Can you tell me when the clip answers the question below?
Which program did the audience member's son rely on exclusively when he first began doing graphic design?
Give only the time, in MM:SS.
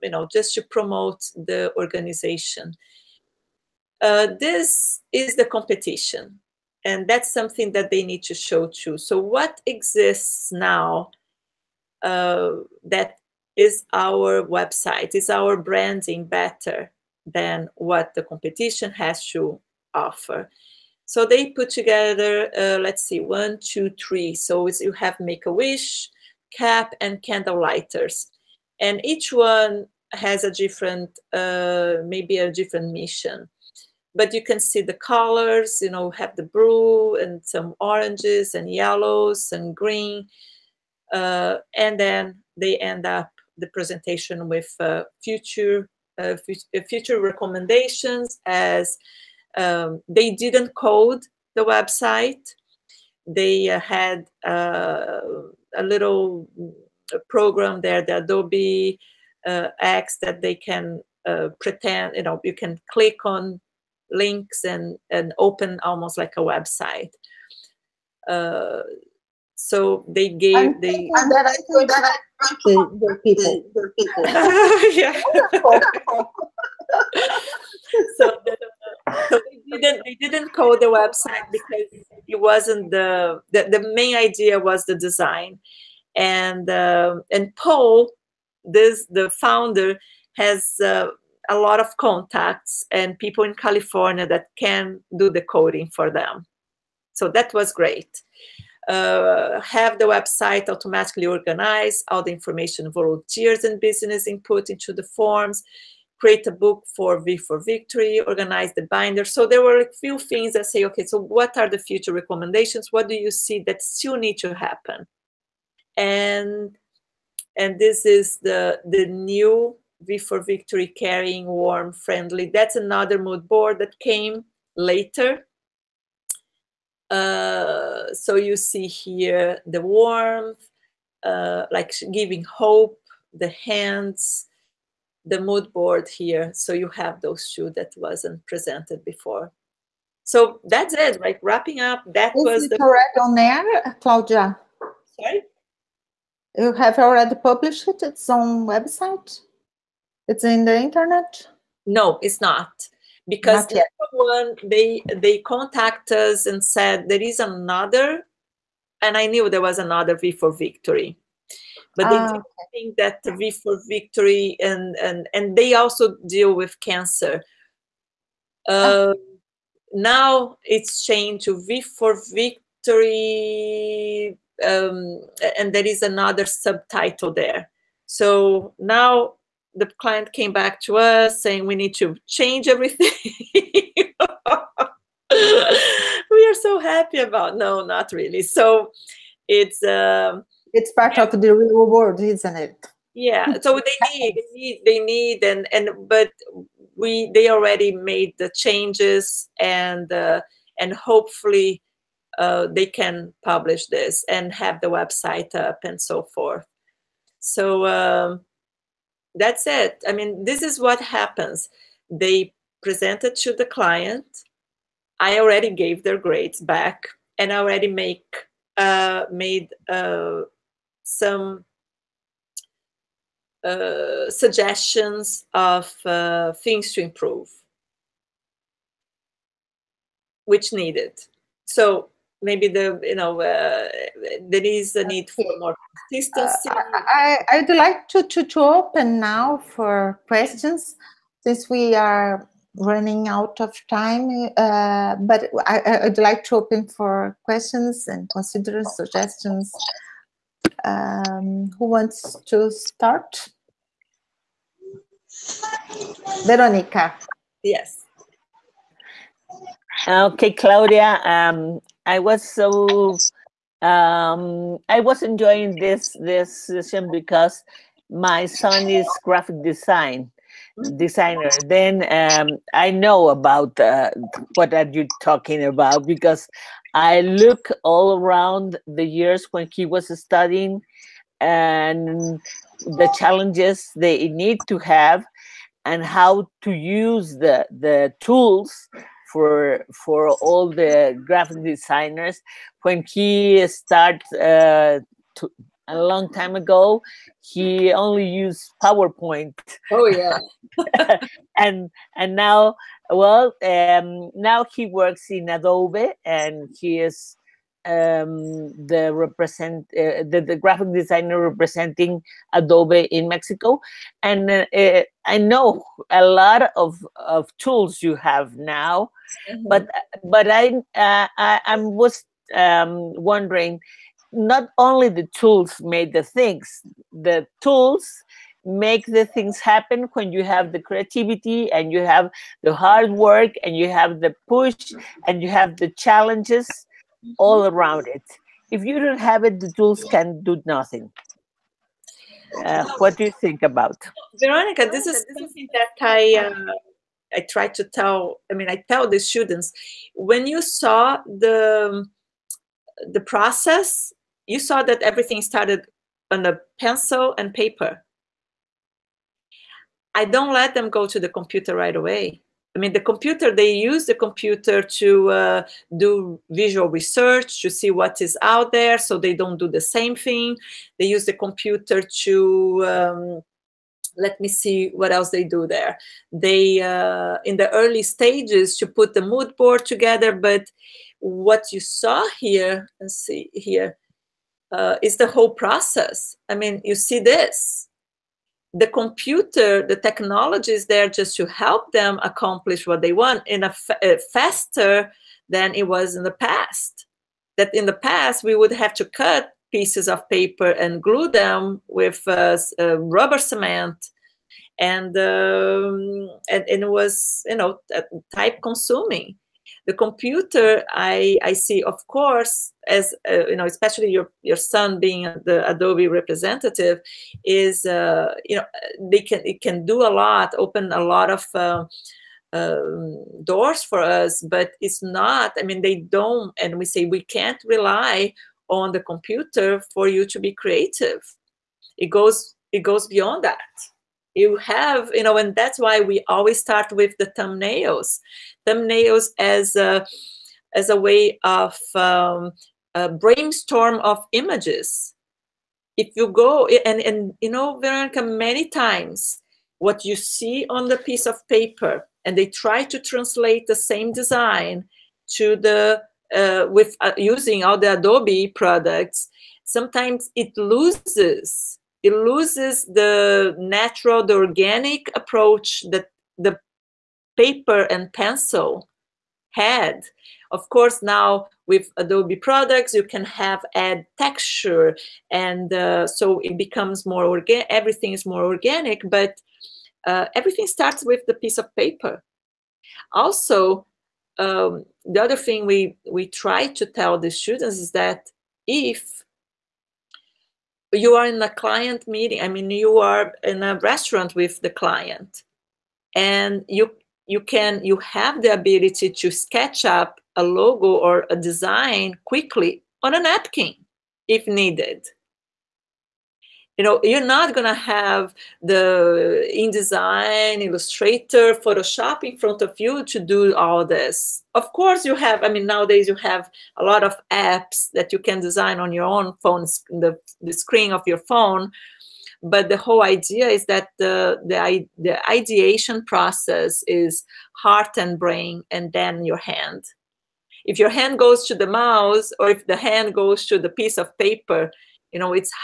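04:58.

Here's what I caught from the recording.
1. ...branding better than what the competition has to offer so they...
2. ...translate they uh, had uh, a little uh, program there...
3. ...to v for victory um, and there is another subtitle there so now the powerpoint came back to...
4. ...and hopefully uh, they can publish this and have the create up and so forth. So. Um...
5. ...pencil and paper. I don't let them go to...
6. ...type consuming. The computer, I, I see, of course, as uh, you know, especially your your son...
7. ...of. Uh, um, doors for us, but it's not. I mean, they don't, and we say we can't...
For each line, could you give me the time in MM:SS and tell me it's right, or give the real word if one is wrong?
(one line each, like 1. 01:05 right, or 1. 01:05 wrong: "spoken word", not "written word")
1. 00:15 right
2. 00:51 wrong: "website", not "translate"
3. 02:51 wrong: "client", not "powerpoint"
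4. 03:20 wrong: "website", not "create"
5. 05:56 right
6. 06:48 right
7. 07:01 right.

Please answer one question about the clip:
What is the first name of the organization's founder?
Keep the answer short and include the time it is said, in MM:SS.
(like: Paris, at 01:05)
Paul, at 01:27.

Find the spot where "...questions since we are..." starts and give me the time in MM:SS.
04:00.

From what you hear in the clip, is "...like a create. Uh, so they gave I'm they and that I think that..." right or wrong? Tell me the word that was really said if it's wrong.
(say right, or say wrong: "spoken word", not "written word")
wrong: "website", not "create".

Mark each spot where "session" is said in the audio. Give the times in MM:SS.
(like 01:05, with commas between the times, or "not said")
04:26.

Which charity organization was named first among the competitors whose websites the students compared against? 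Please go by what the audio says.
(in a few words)
Make a Wish.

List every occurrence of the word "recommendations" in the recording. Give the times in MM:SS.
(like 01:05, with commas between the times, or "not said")
00:47, 01:52.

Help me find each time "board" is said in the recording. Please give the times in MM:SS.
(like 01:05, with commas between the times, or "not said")
02:03, 02:15, 06:19.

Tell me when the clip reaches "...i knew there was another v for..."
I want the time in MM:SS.
02:39.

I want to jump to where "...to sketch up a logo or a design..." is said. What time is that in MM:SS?
08:19.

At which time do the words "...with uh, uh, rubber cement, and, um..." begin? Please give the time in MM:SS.
06:41.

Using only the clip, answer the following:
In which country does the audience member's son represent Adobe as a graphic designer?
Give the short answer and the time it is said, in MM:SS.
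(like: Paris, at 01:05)
Mexico, at 05:13.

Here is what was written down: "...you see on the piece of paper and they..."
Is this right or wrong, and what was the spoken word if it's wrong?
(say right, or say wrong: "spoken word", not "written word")
right.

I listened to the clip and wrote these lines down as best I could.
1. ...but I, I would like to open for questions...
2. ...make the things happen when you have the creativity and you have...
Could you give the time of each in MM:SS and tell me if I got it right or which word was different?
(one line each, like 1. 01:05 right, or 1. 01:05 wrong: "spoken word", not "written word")
1. 04:05 right
2. 05:28 right.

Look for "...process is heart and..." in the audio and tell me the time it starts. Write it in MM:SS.
08:46.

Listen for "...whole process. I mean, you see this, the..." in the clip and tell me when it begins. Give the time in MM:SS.
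06:25.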